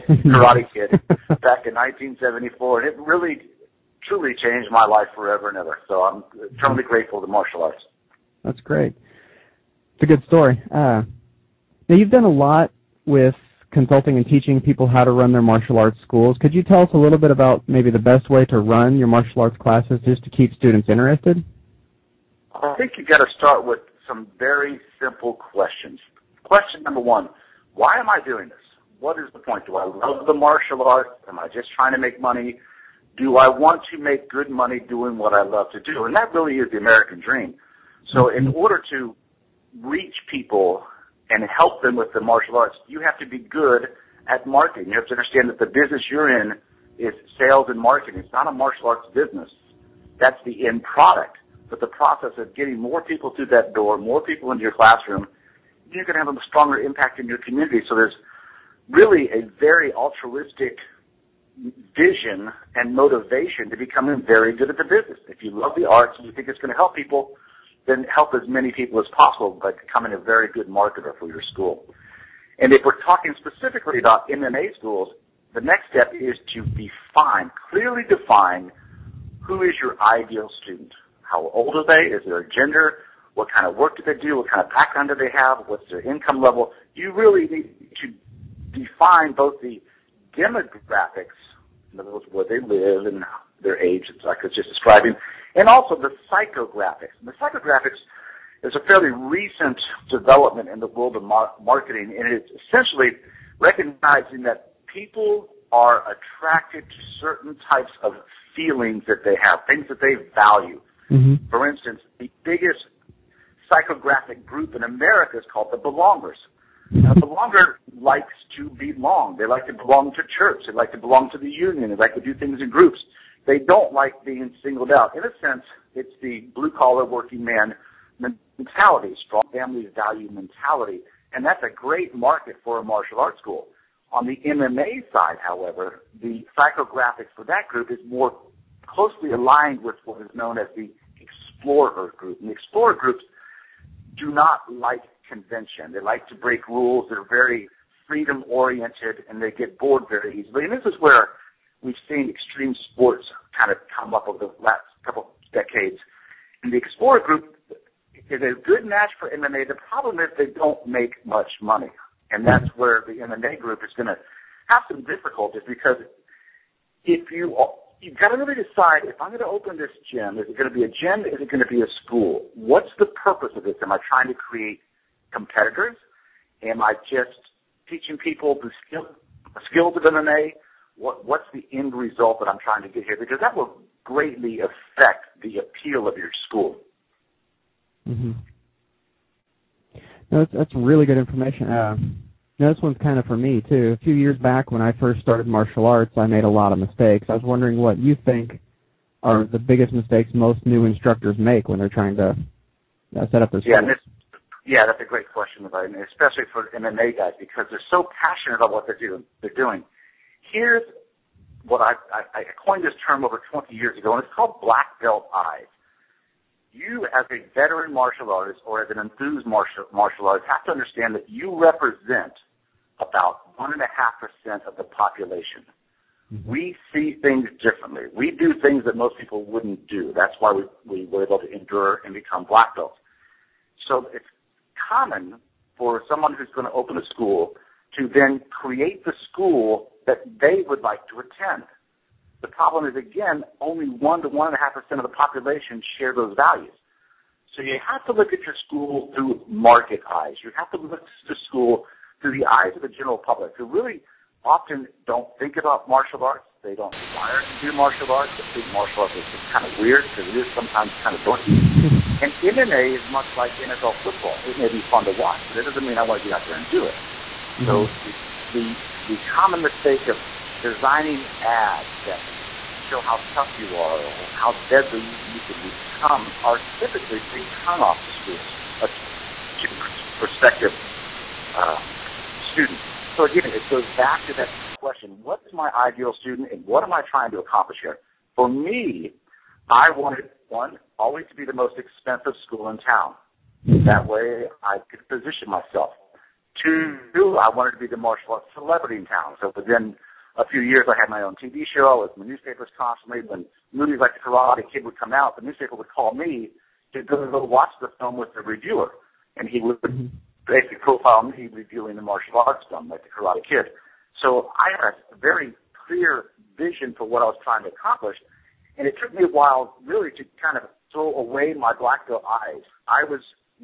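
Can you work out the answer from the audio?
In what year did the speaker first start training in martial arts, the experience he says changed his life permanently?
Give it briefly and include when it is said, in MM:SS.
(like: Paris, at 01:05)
1974, at 00:01.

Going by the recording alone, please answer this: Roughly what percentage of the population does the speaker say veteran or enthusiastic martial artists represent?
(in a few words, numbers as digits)
1.5%.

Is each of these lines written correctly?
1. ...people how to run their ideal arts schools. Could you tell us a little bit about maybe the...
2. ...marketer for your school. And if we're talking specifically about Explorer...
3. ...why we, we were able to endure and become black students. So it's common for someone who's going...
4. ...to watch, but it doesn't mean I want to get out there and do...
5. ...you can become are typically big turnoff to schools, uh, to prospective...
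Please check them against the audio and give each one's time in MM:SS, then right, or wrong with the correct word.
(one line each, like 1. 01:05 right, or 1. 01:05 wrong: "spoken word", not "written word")
1. 00:14 wrong: "martial", not "ideal"
2. 01:10 wrong: "MMA", not "Explorer"
3. 03:50 wrong: "belts", not "students"
4. 04:25 right
5. 04:35 right.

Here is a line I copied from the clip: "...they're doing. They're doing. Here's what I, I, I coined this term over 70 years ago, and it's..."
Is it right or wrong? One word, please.
wrong.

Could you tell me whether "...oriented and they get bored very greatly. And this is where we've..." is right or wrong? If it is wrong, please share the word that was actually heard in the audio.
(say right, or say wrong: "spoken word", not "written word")
wrong: "easily", not "greatly".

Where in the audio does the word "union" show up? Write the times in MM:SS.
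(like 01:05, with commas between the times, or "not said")
02:01.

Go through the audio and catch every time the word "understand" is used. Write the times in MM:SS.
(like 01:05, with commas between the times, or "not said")
00:45, 03:40.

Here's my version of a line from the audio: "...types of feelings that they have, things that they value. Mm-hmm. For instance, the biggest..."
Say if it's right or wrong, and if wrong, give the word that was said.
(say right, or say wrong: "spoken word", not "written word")
right.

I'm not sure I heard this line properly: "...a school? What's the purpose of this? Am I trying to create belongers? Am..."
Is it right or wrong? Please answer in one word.
wrong.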